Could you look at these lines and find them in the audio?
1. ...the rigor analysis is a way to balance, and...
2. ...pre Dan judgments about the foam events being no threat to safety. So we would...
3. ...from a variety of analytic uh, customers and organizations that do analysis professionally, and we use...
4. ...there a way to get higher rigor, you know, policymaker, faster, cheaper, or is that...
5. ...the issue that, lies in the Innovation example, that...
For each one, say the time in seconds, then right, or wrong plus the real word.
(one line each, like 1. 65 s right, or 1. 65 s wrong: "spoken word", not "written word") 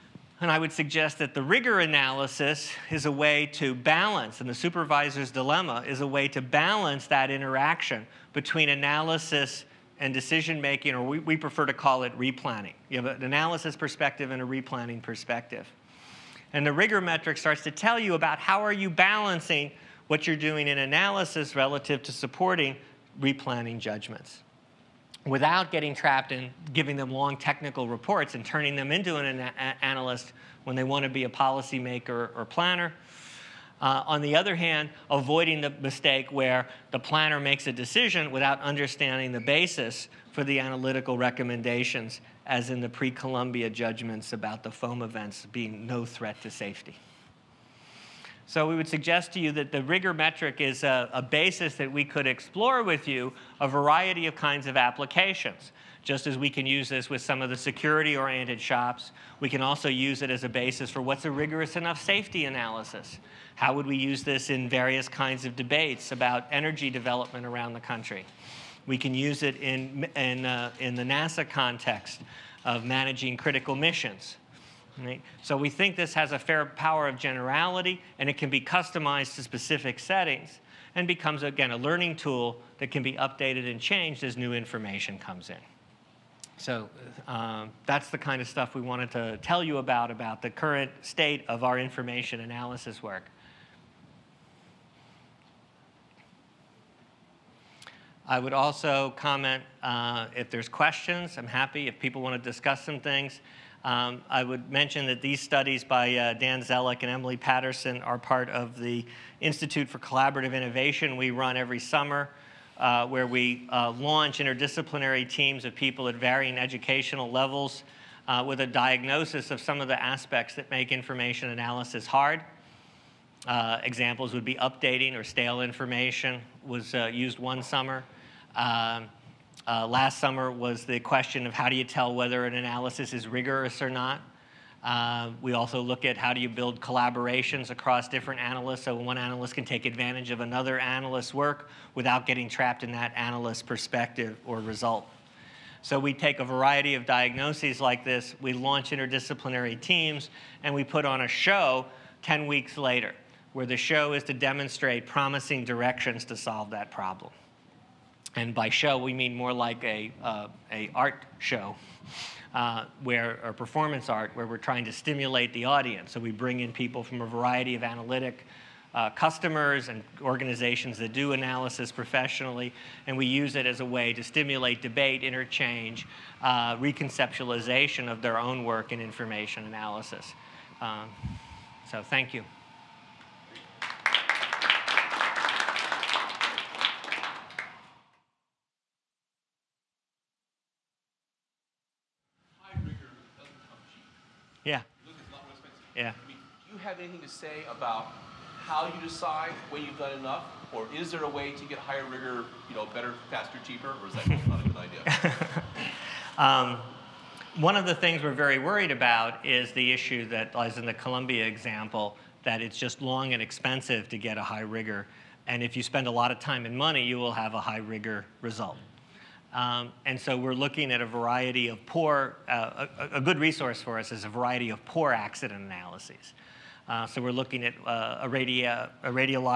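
1. 1 s right
2. 42 s wrong: "Columbia", not "Dan"
3. 167 s right
4. 201 s wrong: "better", not "policymaker"
5. 209 s wrong: "Columbia", not "Innovation".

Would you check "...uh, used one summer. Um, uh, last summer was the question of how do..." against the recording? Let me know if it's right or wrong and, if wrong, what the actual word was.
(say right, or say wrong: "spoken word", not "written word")
right.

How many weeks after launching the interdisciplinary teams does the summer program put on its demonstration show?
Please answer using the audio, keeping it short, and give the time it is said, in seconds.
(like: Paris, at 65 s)
10, at 152 s.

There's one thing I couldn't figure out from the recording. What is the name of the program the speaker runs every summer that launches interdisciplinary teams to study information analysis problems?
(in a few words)
Institute for Collaborative Innovation.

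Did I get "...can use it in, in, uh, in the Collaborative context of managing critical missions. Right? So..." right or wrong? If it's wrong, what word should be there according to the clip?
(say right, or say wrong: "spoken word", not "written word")
wrong: "NASA", not "Collaborative".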